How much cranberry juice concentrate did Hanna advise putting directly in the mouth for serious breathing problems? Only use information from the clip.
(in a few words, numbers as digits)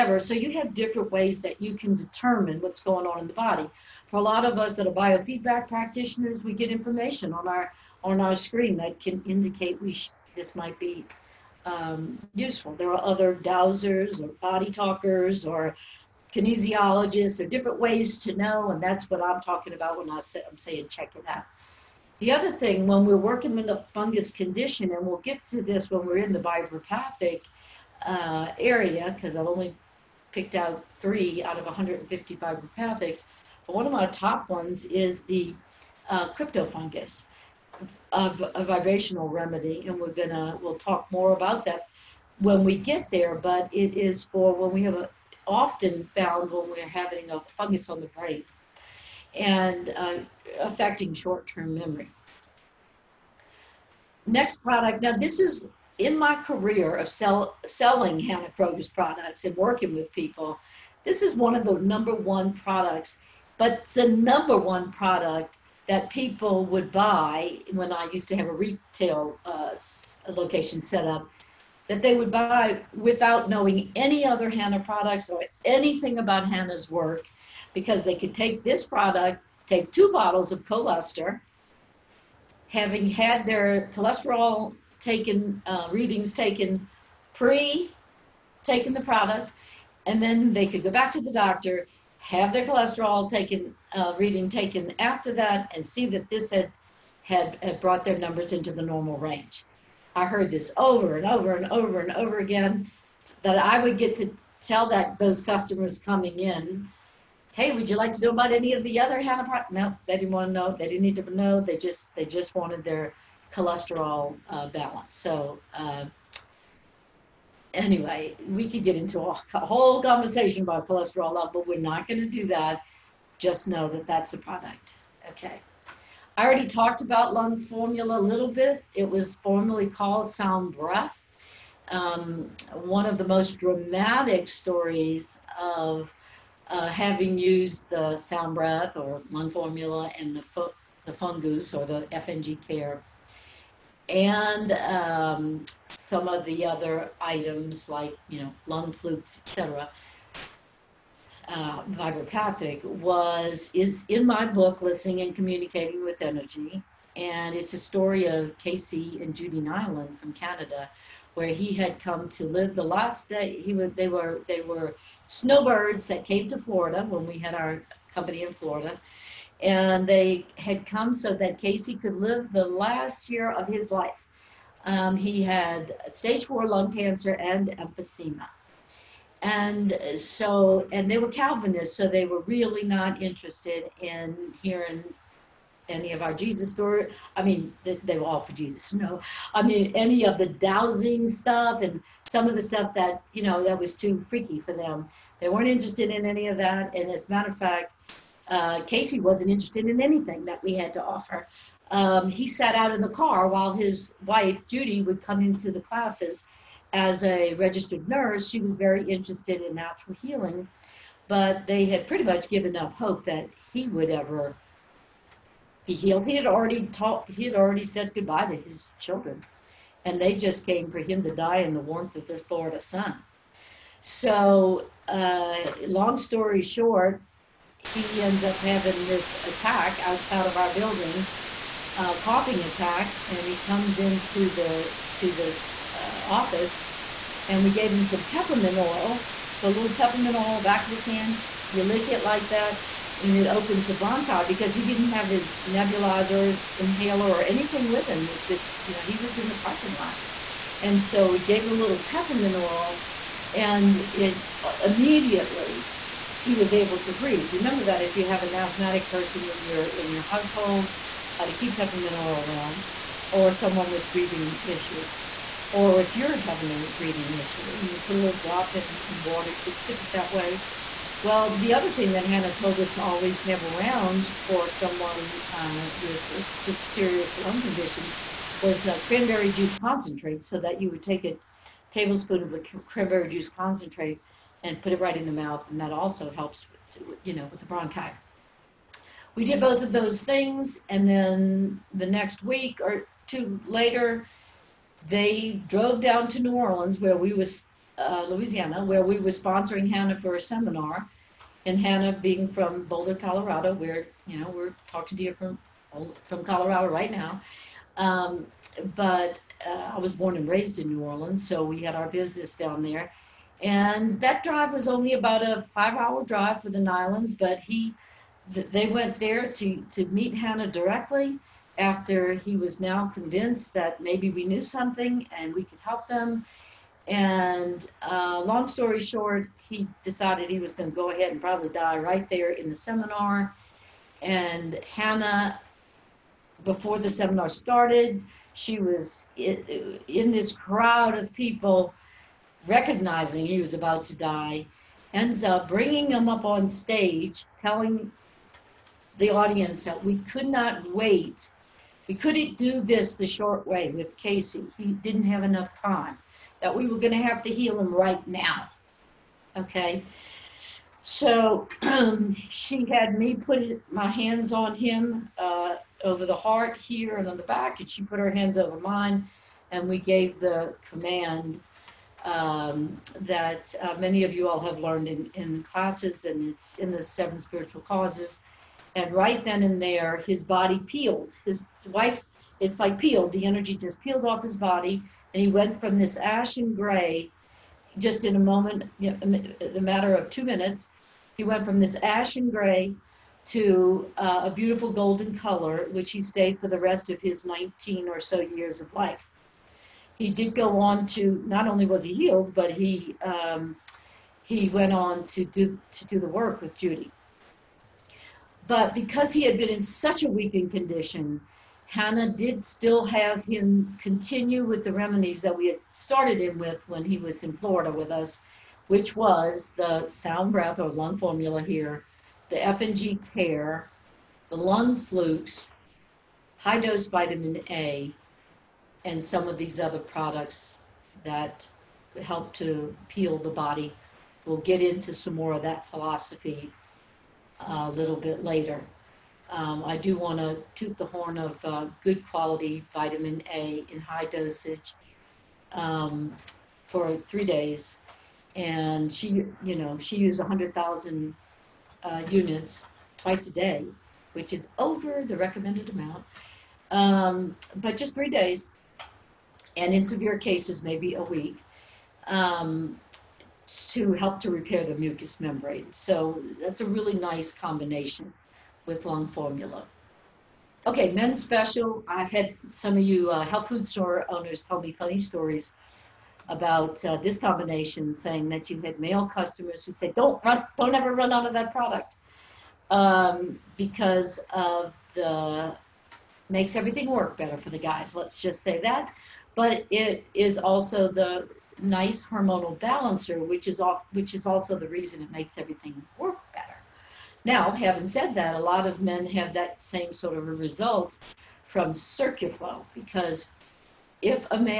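A tablespoon.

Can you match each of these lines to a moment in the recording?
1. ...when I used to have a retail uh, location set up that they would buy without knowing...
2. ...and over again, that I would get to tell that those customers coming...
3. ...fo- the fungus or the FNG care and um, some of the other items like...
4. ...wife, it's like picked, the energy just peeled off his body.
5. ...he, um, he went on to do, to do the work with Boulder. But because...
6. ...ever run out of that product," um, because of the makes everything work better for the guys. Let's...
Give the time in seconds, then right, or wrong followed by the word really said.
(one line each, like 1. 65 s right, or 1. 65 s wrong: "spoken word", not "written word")
1. 67 s right
2. 102 s right
3. 140 s right
4. 381 s wrong: "peeled", not "picked"
5. 402 s wrong: "Judy", not "Boulder"
6. 480 s right.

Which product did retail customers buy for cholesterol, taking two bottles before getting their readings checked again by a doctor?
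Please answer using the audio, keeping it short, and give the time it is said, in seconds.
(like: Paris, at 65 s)
Coluster, at 80 s.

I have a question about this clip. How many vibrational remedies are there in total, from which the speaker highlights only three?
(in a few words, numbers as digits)
150.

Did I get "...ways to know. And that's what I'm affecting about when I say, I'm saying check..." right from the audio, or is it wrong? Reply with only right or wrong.
wrong.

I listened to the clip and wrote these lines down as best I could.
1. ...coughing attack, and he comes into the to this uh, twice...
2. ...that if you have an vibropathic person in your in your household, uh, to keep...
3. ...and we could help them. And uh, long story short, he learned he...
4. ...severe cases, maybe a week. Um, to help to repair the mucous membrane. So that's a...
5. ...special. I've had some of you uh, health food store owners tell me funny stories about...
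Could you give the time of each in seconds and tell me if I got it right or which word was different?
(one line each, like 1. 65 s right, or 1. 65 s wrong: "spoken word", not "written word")
1. 232 s wrong: "office", not "twice"
2. 257 s wrong: "asthmatic", not "vibropathic"
3. 325 s wrong: "decided", not "learned"
4. 460 s right
5. 471 s right.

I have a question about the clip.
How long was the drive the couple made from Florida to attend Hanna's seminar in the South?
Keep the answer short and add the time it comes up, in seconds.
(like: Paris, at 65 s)
5 hours, at 315 s.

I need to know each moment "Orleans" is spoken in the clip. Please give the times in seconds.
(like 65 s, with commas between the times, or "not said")
296 s, 311 s.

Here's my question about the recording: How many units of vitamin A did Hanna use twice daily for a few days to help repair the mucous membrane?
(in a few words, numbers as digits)
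100,000.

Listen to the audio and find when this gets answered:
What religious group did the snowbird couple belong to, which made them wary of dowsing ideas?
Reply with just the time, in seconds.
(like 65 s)
181 s.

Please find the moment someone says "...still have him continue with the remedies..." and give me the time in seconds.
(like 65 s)
412 s.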